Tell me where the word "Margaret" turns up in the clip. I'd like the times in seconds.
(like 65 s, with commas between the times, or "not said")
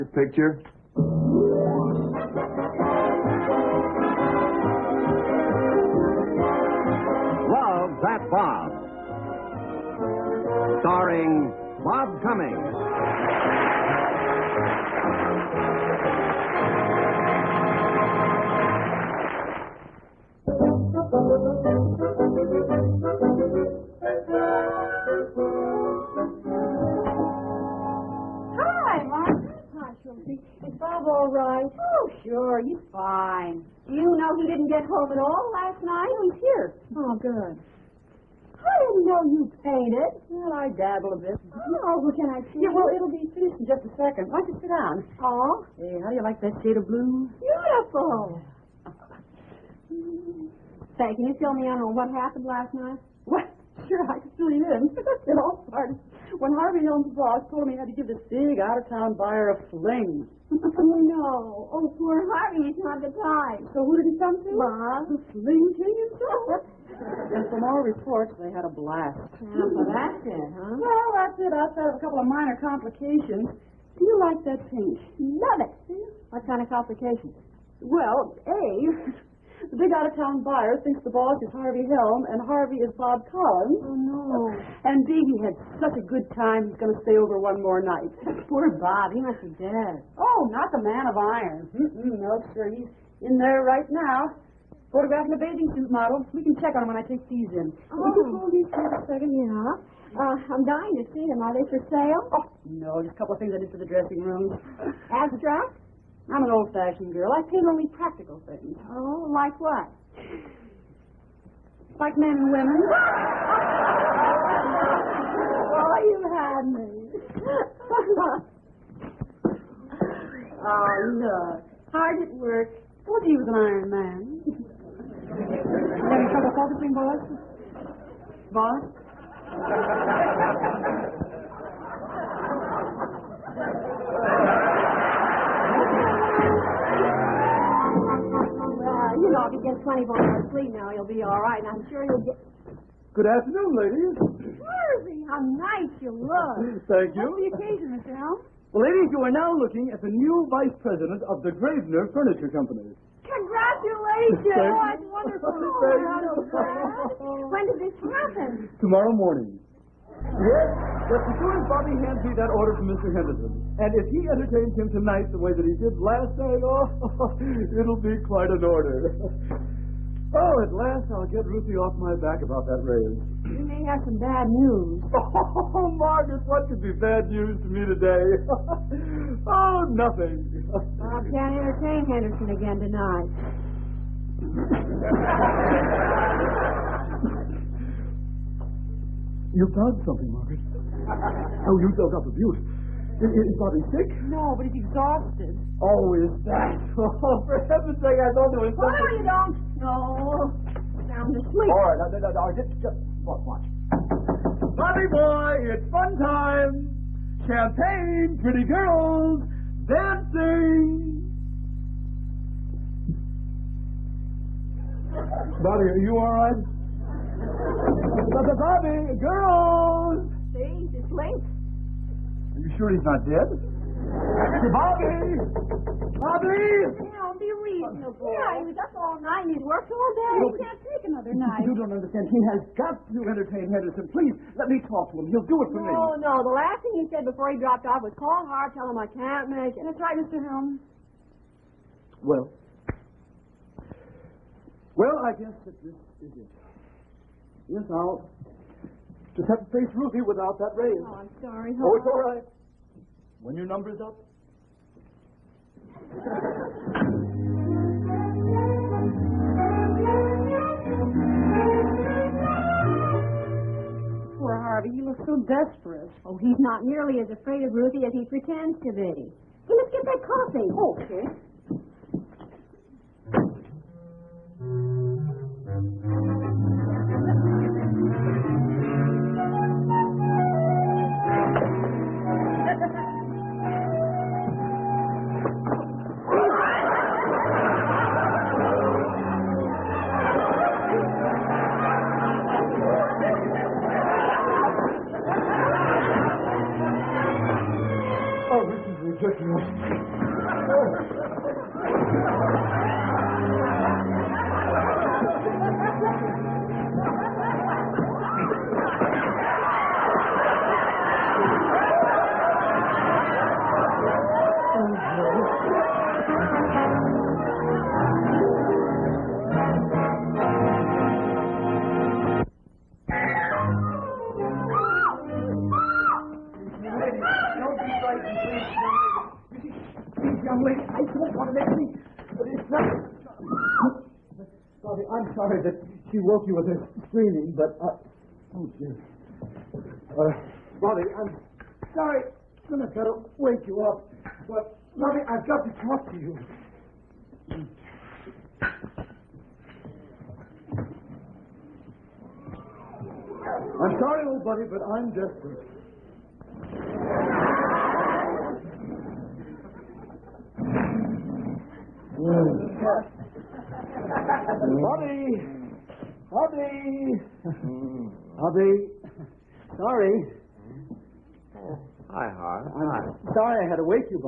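175 s, 190 s.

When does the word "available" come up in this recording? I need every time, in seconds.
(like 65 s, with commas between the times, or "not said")
not said.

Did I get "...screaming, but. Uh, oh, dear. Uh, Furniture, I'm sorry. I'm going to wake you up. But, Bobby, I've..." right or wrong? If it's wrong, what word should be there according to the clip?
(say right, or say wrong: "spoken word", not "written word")
wrong: "Bobby", not "Furniture".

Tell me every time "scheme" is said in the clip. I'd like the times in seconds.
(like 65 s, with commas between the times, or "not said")
not said.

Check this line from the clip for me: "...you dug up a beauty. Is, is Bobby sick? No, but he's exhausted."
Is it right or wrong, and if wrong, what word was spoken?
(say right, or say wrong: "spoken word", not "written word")
right.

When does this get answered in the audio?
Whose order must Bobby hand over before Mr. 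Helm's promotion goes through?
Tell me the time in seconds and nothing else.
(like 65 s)
162 s.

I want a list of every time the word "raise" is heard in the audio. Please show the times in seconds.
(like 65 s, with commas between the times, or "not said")
172 s, 250 s.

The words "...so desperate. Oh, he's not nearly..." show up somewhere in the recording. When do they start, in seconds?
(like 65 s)
265 s.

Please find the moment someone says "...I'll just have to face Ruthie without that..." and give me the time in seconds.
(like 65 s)
247 s.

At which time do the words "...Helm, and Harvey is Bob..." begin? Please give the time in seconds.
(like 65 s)
81 s.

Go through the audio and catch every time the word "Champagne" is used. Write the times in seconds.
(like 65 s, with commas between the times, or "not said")
207 s.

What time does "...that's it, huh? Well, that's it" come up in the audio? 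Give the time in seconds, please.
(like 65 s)
69 s.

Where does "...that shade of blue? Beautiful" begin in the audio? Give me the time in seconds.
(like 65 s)
46 s.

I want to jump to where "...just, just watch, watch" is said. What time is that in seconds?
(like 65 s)
202 s.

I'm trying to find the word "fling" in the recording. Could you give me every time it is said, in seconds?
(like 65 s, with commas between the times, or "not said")
59 s, 65 s.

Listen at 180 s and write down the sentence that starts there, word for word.
Bob can't entertain Henderson again tonight.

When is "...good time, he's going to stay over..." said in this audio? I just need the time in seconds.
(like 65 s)
86 s.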